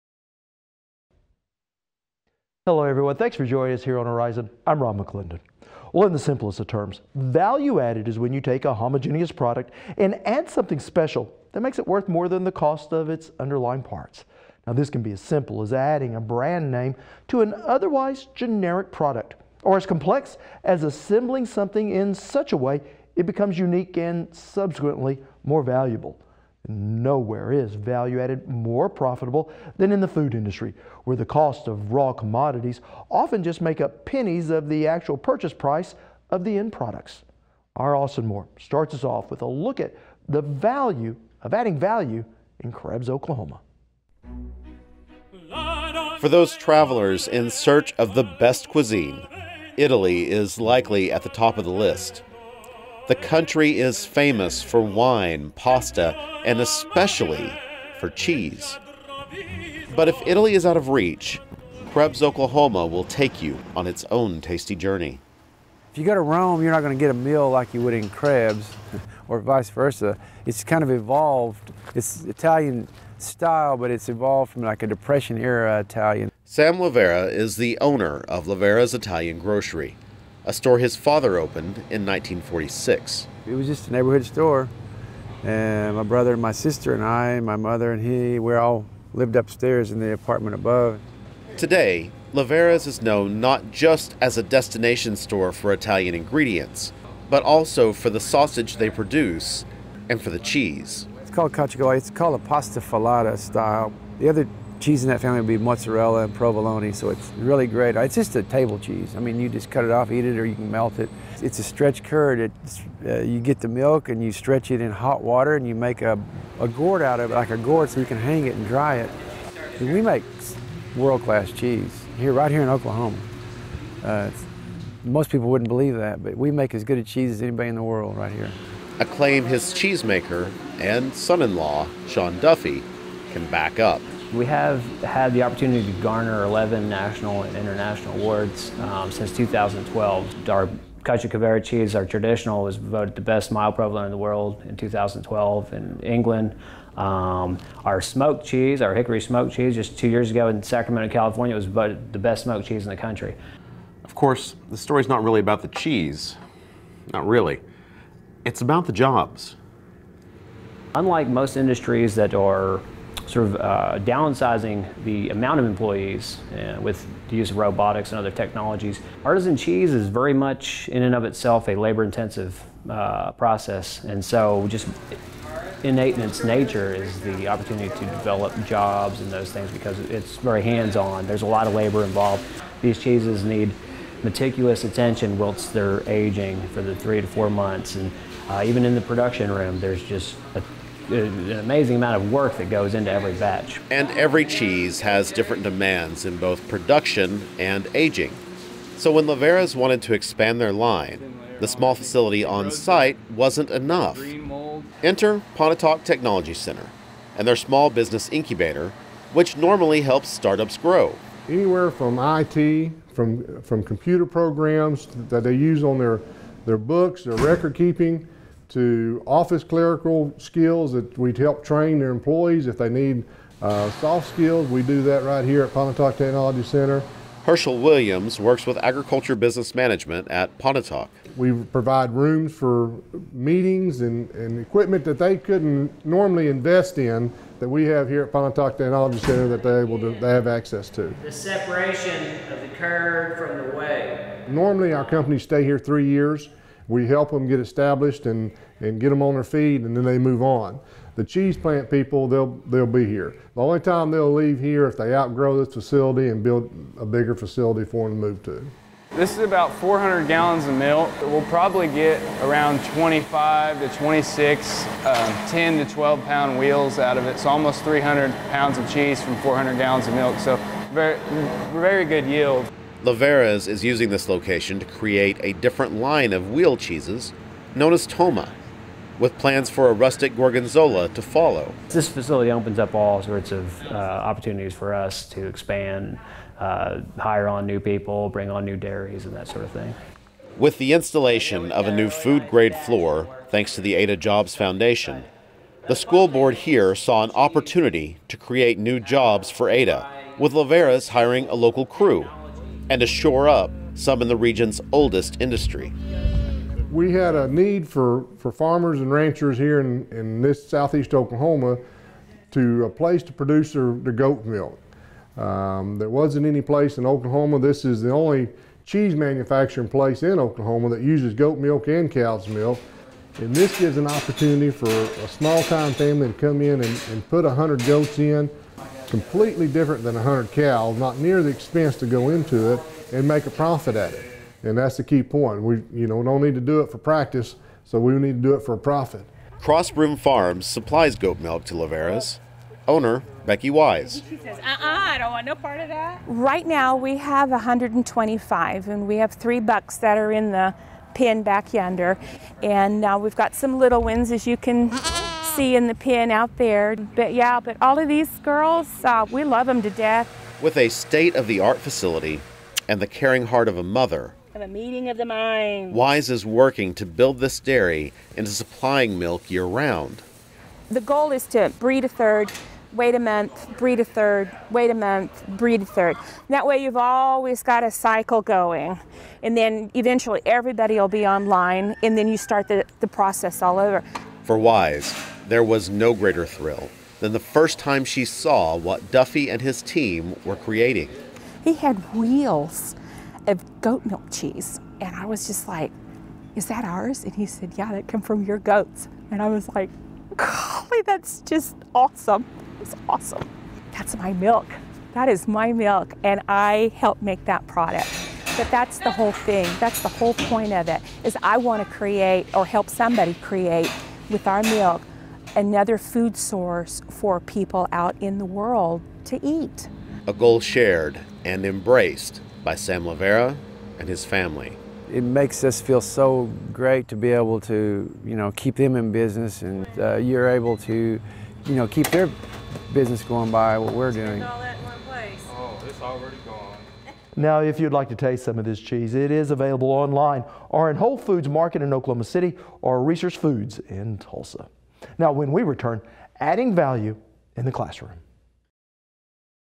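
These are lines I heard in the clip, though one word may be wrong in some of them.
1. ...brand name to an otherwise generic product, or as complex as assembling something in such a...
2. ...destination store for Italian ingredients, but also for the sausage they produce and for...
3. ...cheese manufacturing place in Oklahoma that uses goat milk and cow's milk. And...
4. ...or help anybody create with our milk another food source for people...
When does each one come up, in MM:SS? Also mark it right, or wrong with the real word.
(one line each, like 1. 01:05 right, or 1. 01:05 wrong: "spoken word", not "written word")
1. 00:16 right
2. 01:34 right
3. 05:18 right
4. 06:52 wrong: "somebody", not "anybody".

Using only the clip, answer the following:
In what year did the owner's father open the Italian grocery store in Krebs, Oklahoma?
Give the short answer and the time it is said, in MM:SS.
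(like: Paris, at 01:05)
1946, at 01:22.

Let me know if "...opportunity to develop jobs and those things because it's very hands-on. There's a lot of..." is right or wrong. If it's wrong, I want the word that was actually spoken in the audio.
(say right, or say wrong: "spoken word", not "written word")
right.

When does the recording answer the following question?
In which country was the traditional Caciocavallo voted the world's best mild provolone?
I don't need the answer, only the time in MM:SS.
02:26.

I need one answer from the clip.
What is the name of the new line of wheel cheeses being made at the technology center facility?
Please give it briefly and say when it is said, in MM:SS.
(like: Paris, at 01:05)
Toma, at 04:38.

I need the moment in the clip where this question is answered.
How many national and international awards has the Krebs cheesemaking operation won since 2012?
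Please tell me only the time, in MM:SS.
02:16.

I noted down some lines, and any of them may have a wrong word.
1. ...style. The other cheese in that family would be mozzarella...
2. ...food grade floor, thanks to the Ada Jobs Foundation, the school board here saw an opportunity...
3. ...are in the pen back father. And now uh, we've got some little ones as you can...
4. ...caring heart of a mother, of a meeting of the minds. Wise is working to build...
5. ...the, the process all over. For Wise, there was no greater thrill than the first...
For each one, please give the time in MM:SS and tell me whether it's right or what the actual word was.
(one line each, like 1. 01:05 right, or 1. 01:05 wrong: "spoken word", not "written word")
1. 01:43 right
2. 04:52 right
3. 05:50 wrong: "yonder", not "father"
4. 06:03 right
5. 06:22 right.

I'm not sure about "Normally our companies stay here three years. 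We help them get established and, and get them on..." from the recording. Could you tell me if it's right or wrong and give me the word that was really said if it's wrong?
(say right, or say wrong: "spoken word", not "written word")
right.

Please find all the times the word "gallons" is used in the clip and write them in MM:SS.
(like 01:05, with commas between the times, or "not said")
04:20, 04:29.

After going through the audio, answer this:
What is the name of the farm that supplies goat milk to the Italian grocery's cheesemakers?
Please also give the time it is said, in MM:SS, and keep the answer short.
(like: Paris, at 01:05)
Cross Broom Farms, at 05:39.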